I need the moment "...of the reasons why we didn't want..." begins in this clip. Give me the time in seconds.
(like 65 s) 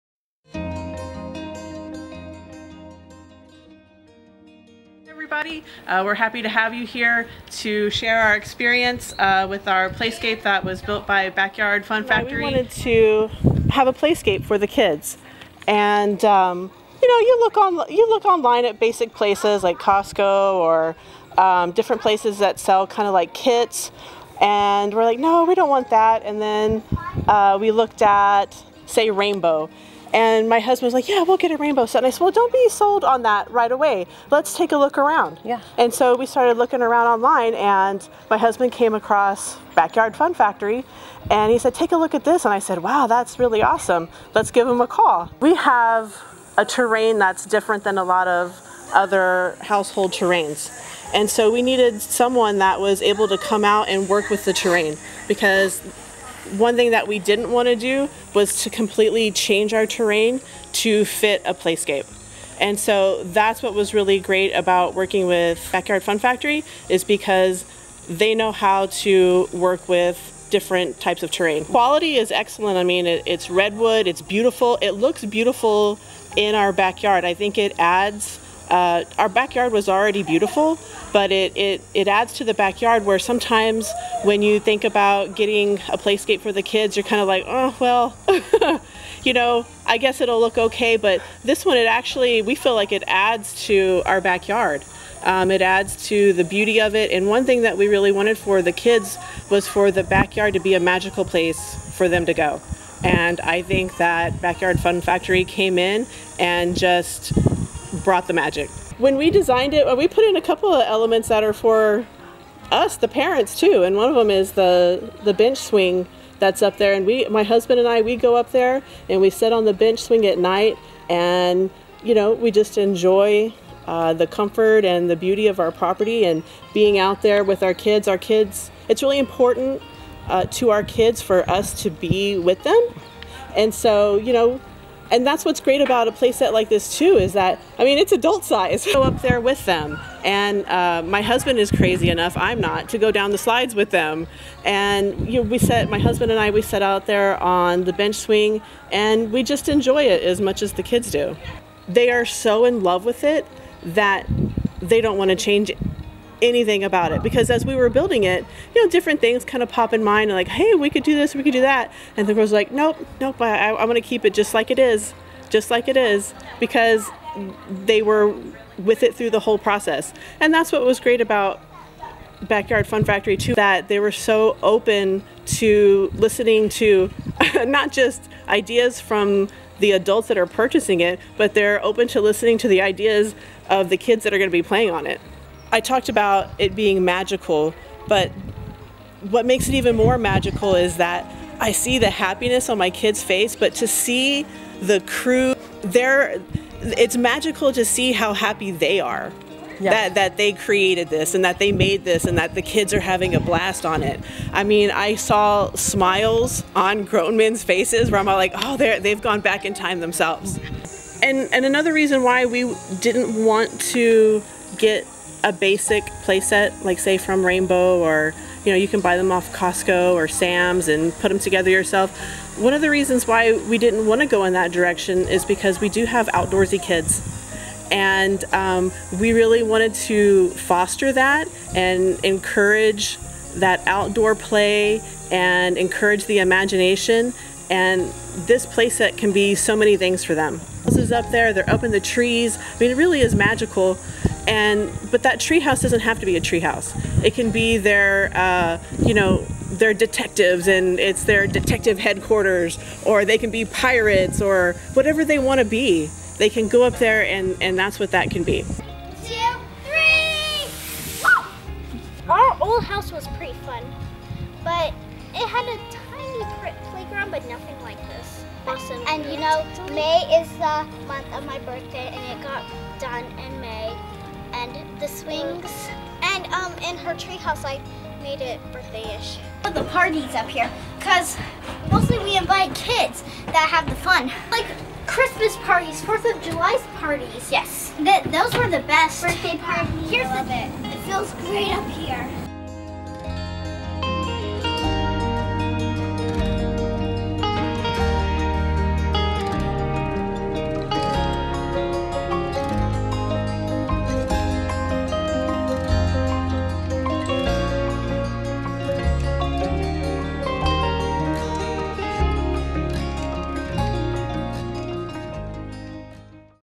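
222 s.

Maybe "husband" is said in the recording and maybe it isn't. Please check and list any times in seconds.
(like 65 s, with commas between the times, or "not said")
30 s, 38 s, 117 s, 141 s, 145 s.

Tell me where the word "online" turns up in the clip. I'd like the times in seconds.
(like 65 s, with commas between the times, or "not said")
18 s, 37 s.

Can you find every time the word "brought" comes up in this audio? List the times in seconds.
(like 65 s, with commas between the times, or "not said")
108 s.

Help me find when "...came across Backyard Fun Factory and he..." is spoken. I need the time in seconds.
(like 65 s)
38 s.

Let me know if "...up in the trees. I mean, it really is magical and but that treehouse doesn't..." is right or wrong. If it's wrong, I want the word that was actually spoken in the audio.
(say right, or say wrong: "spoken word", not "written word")
right.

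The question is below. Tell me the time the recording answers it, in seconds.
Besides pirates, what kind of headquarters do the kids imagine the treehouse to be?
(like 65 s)
251 s.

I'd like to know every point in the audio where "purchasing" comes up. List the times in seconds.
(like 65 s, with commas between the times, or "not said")
180 s.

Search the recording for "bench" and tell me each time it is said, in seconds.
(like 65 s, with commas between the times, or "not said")
115 s, 119 s, 147 s.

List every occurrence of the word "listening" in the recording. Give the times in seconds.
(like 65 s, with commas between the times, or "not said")
176 s, 182 s.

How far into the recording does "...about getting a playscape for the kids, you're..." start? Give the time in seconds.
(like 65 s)
84 s.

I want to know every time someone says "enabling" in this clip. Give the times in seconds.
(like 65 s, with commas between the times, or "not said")
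not said.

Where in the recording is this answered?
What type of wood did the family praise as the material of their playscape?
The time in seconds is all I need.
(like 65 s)
73 s.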